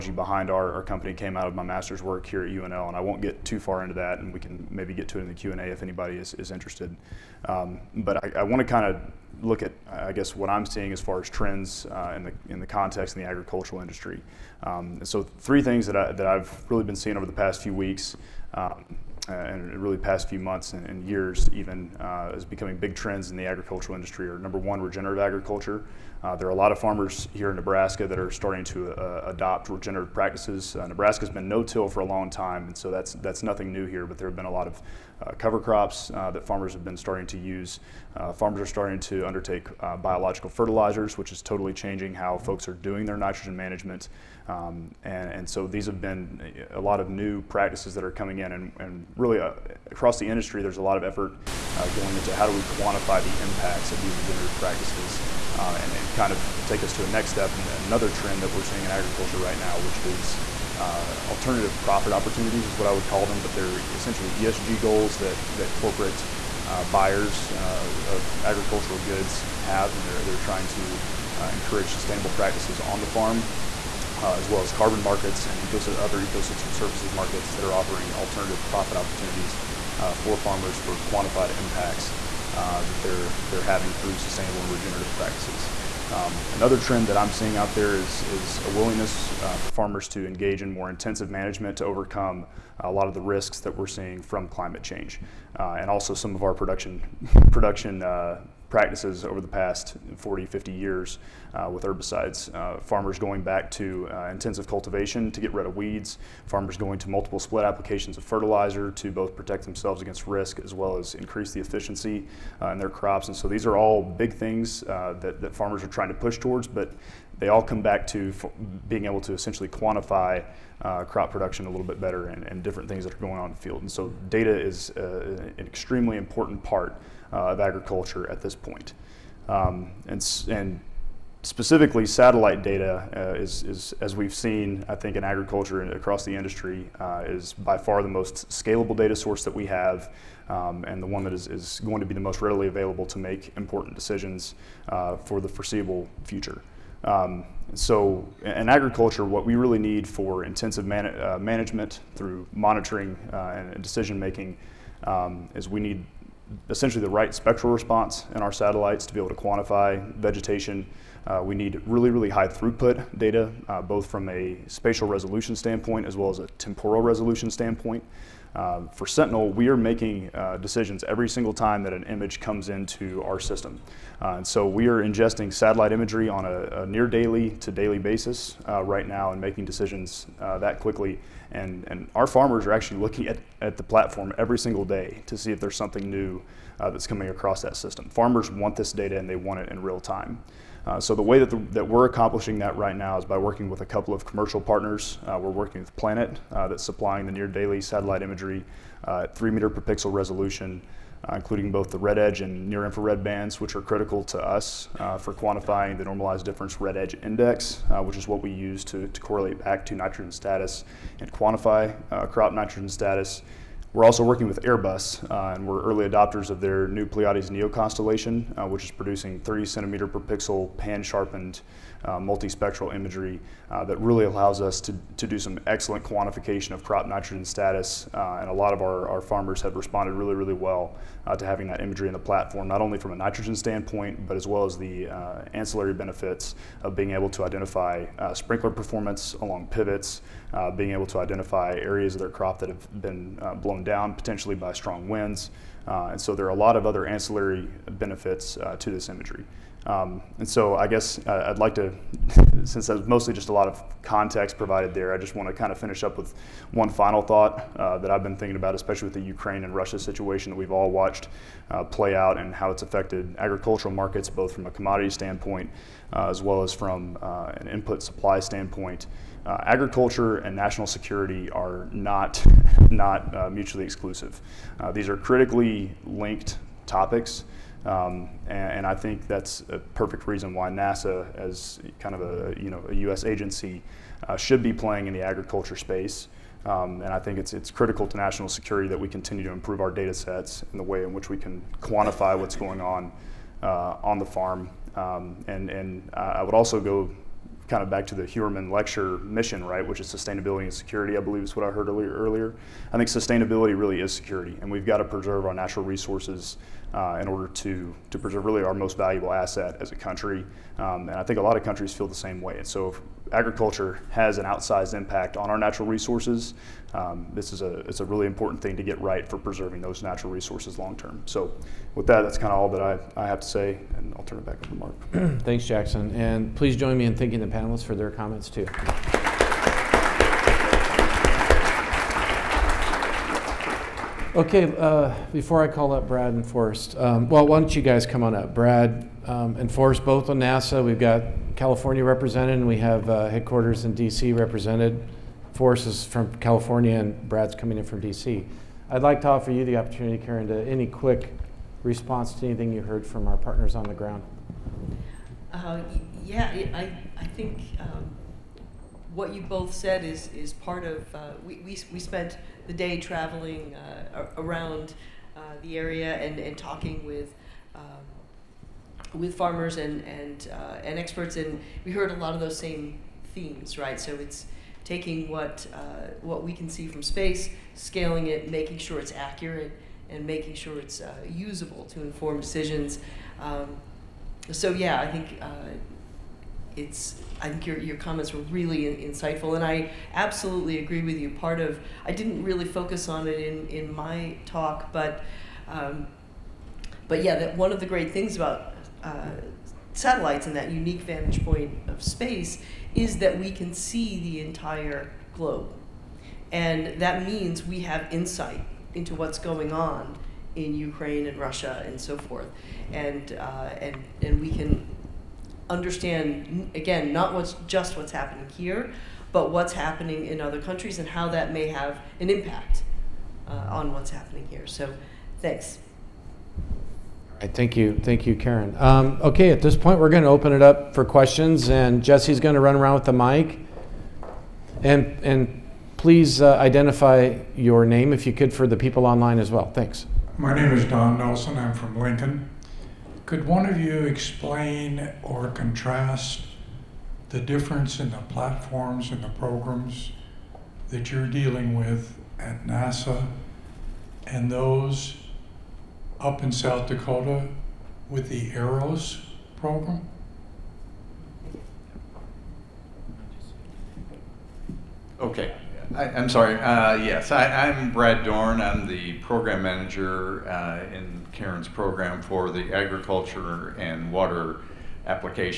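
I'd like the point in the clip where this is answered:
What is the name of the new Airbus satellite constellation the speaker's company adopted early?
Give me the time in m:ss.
3:37.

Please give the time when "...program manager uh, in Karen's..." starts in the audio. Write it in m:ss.
7:49.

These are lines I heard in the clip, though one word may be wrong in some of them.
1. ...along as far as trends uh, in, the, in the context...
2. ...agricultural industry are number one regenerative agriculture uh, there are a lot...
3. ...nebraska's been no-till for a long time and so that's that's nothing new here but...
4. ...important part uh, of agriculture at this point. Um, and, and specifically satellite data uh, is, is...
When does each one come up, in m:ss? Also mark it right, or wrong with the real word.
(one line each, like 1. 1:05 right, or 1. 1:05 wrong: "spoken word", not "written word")
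1. 0:10 wrong: "seeing", not "along"
2. 0:23 right
3. 0:30 right
4. 2:06 right.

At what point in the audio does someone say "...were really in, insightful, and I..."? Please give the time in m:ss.
6:28.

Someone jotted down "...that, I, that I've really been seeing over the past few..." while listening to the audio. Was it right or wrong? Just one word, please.
right.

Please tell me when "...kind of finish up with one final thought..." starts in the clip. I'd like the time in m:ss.
4:15.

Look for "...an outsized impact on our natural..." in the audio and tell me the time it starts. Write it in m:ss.
5:14.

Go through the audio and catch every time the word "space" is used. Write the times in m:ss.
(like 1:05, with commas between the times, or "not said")
4:45, 6:17, 6:42.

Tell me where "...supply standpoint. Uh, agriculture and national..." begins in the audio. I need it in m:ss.
4:28.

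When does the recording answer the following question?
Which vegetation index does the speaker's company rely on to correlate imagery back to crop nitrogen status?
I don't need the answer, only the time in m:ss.
3:26.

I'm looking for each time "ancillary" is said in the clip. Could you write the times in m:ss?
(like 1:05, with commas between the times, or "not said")
3:55, 4:07.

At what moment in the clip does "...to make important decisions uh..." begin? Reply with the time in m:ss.
2:23.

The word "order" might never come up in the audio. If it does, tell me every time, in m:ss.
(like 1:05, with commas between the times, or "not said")
5:07.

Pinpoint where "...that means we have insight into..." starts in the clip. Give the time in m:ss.
6:47.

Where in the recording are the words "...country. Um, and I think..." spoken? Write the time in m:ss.
5:09.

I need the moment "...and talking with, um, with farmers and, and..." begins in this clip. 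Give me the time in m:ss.
6:06.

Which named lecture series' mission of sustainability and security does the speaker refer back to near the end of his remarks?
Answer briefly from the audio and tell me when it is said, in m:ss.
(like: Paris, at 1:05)
Heuermann lecture, at 4:58.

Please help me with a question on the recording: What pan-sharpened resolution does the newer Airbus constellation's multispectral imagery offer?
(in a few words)
30 centimeters per pixel.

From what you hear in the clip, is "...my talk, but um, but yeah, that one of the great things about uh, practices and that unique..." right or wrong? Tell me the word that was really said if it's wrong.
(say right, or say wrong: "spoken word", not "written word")
wrong: "satellites", not "practices".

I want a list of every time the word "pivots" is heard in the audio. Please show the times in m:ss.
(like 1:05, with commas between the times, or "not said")
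3:59.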